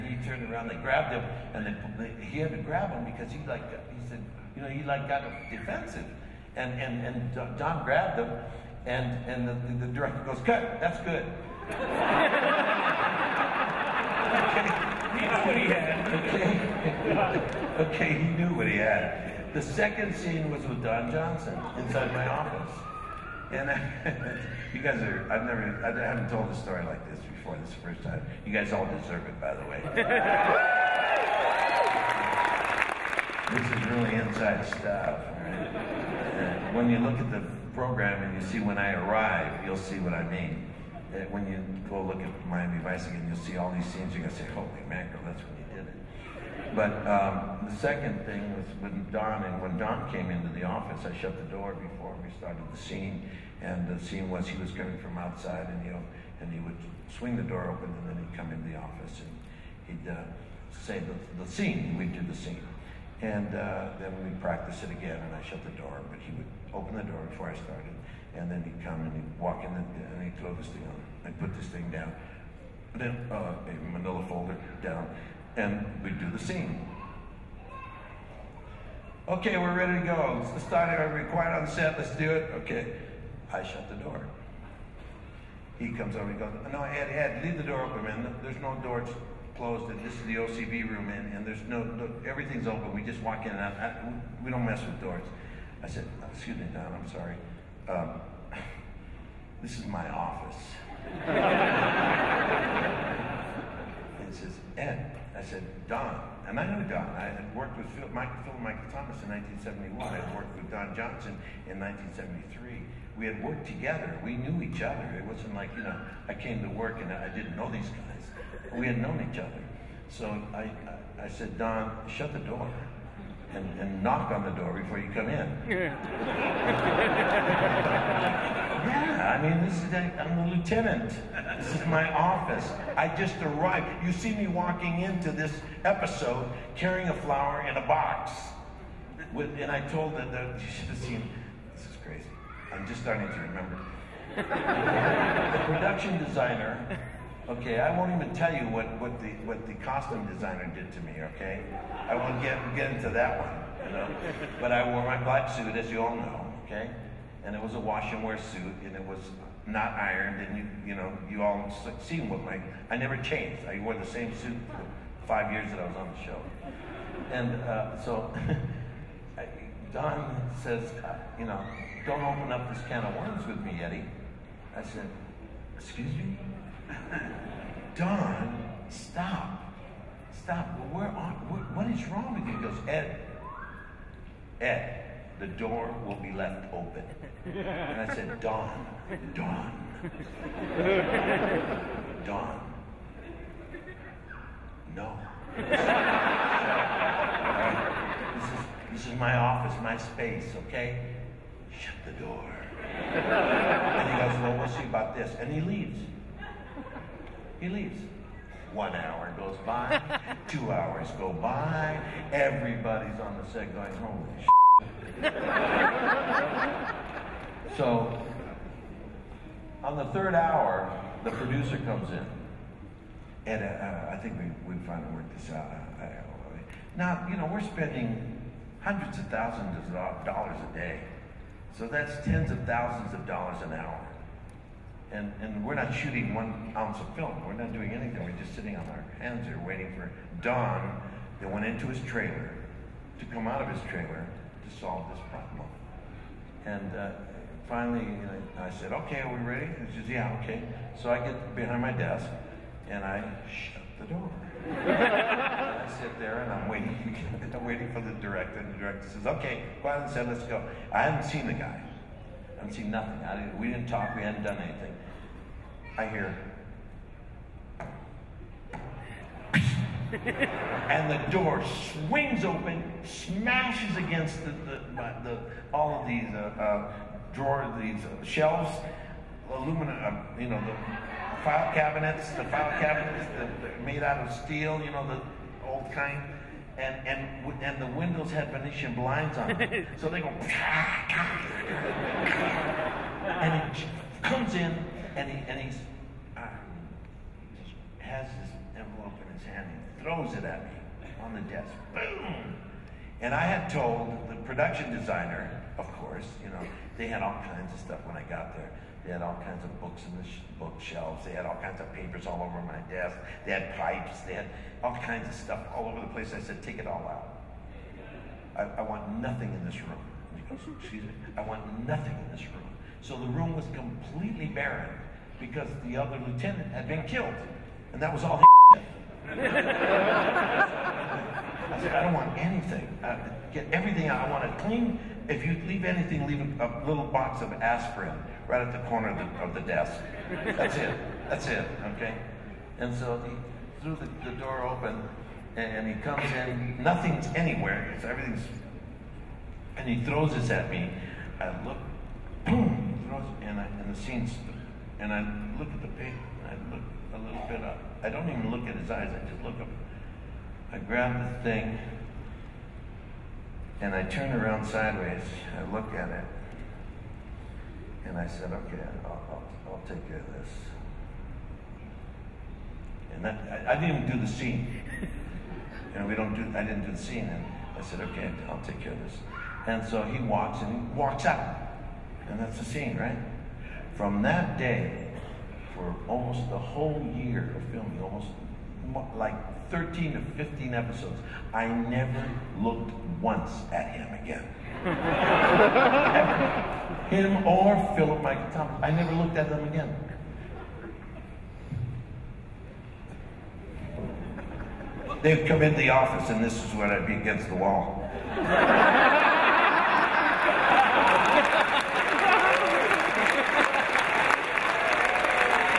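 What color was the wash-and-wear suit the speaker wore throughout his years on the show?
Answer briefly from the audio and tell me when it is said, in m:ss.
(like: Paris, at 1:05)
black, at 2:35.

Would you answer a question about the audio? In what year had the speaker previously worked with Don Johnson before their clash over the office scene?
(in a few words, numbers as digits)
1973.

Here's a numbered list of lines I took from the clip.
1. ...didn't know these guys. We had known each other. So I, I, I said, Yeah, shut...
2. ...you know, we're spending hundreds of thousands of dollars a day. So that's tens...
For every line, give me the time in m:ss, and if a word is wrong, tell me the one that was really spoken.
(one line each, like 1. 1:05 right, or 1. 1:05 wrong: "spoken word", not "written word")
1. 1:57 wrong: "Don", not "Yeah"
2. 3:47 right.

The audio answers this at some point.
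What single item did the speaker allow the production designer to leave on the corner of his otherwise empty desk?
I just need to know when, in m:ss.
5:37.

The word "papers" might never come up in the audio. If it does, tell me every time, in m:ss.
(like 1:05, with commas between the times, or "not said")
5:11, 5:55.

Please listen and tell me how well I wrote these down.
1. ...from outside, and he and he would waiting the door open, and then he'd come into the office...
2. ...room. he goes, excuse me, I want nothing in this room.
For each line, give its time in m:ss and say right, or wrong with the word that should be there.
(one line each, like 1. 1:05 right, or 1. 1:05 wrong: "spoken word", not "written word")
1. 0:54 wrong: "swing", not "waiting"
2. 5:19 right.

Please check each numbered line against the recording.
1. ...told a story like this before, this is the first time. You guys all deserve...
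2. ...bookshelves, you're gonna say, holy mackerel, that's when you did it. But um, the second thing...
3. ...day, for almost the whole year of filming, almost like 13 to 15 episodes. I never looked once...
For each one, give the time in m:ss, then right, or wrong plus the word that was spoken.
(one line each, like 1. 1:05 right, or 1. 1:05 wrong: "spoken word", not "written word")
1. 0:26 right
2. 0:43 wrong: "scenes", not "bookshelves"
3. 6:24 right.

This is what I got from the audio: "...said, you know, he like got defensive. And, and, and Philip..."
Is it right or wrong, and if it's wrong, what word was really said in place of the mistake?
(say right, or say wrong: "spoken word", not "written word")
wrong: "Don", not "Philip".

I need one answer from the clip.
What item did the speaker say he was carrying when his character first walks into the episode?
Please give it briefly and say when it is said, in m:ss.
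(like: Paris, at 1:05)
a flower in a box, at 2:17.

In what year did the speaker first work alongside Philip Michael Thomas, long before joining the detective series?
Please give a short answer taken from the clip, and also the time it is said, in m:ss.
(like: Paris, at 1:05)
1971, at 1:49.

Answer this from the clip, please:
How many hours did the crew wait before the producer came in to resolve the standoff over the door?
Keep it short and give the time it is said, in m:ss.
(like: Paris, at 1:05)
3, at 3:40.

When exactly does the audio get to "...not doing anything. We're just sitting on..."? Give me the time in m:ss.
3:57.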